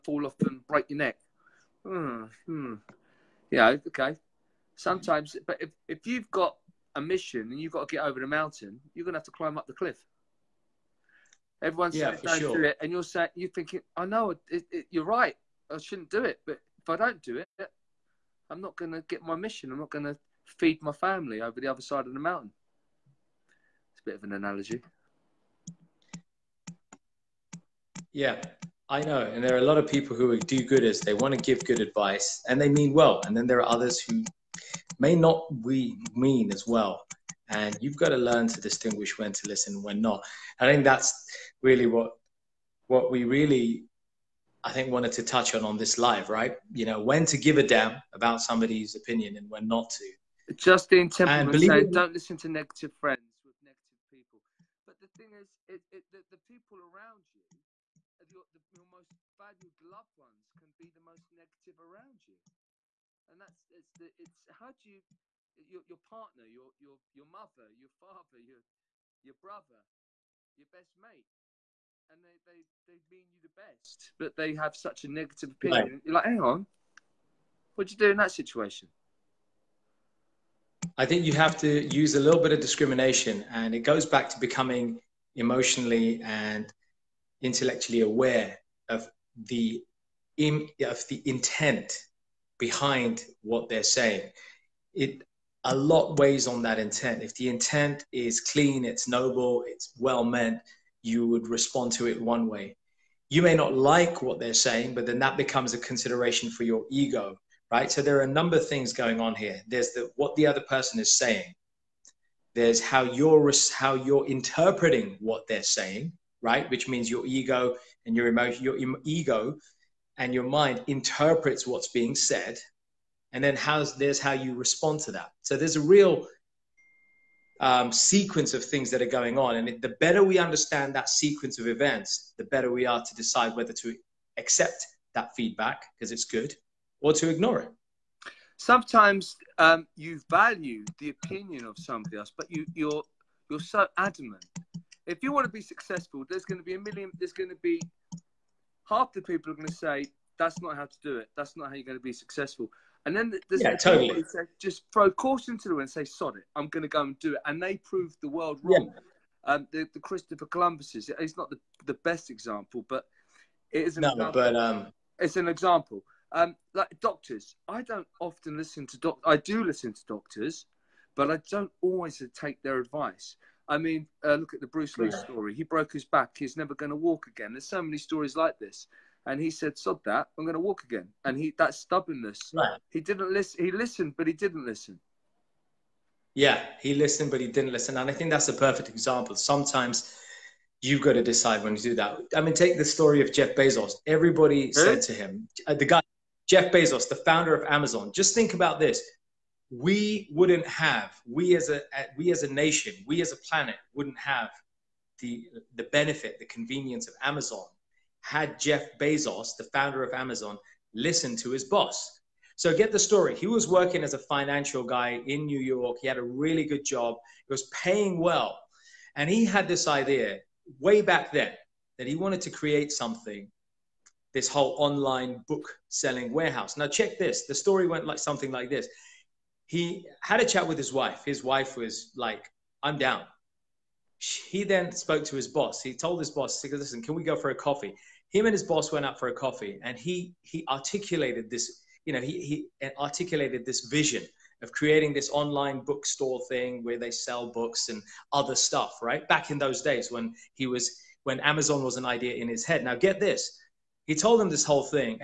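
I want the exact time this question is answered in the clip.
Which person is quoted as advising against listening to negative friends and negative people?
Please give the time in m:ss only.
0:50.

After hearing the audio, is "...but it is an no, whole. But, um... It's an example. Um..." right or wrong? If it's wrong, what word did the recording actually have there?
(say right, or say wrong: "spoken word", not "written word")
wrong: "example", not "whole".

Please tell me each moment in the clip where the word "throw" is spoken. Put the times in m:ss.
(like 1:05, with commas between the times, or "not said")
2:34.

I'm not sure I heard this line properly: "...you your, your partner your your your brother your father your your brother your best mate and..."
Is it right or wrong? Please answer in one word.
wrong.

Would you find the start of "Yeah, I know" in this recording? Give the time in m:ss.
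0:28.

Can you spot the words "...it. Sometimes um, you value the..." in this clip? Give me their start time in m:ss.
2:17.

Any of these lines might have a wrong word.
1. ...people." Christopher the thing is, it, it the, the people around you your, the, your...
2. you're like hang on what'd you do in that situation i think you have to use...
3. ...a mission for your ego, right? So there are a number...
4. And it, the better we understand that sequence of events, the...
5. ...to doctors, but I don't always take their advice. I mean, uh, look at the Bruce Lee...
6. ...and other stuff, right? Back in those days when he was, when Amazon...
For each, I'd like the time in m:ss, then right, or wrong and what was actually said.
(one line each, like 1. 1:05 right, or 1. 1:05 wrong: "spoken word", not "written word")
1. 0:54 wrong: "But", not "Christopher"
2. 1:16 right
3. 1:45 wrong: "consideration", not "mission"
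4. 2:09 right
5. 2:49 right
6. 4:07 right.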